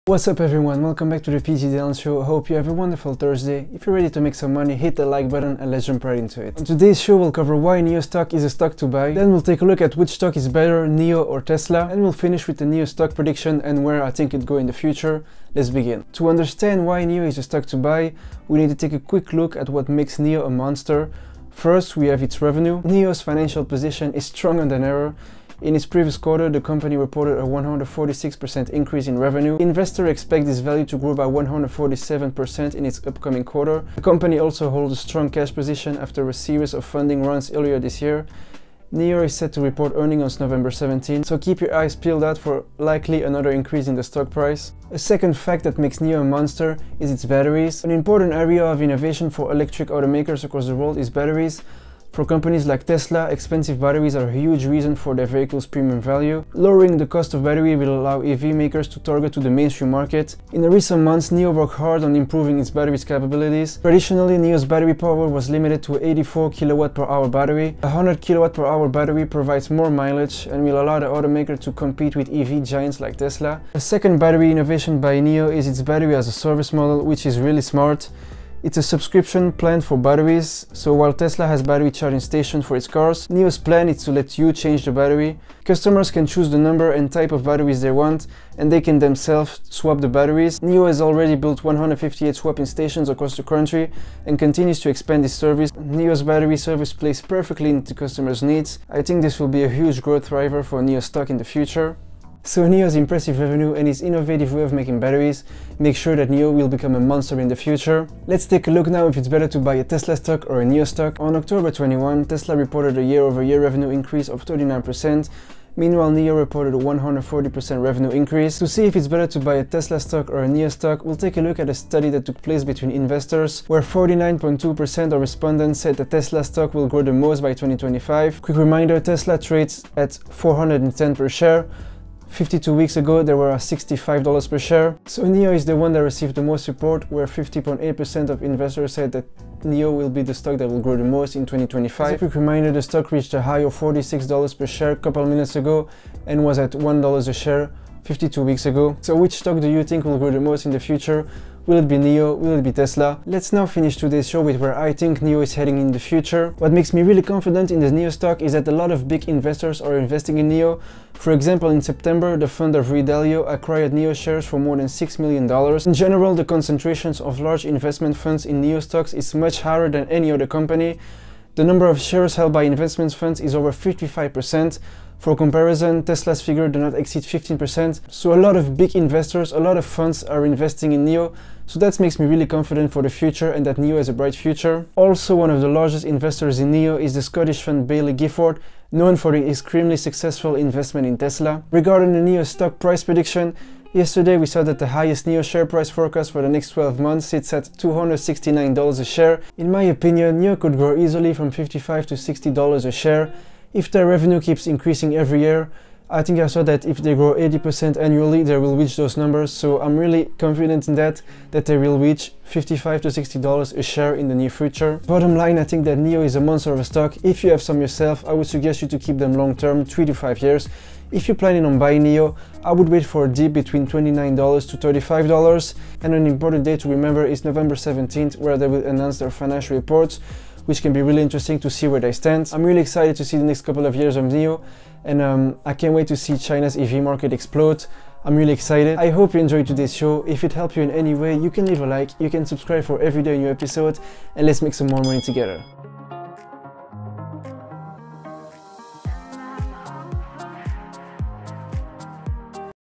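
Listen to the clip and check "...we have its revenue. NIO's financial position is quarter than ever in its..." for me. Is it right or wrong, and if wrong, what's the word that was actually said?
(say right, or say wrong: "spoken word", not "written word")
wrong: "stronger", not "quarter".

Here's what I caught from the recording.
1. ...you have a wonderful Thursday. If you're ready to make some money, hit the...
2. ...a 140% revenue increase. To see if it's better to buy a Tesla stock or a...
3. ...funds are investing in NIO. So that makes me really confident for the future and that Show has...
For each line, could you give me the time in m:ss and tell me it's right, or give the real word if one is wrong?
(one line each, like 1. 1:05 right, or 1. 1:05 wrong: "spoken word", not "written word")
1. 0:02 right
2. 1:56 right
3. 2:59 wrong: "NIO", not "Show".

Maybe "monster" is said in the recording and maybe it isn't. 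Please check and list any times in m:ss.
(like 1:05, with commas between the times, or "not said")
0:20, 0:46, 1:46, 3:36.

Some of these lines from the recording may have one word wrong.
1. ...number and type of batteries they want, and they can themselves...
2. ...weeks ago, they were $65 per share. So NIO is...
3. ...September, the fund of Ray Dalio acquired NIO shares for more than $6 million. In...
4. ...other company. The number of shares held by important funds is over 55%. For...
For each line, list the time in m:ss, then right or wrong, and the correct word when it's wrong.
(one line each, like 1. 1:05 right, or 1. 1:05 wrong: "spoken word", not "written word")
1. 1:26 right
2. 2:12 right
3. 2:41 right
4. 2:50 wrong: "investment", not "important".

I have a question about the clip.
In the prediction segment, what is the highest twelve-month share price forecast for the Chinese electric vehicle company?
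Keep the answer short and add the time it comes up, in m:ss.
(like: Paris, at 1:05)
$269, at 3:17.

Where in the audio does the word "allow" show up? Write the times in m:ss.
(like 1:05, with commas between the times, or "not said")
0:58, 1:10.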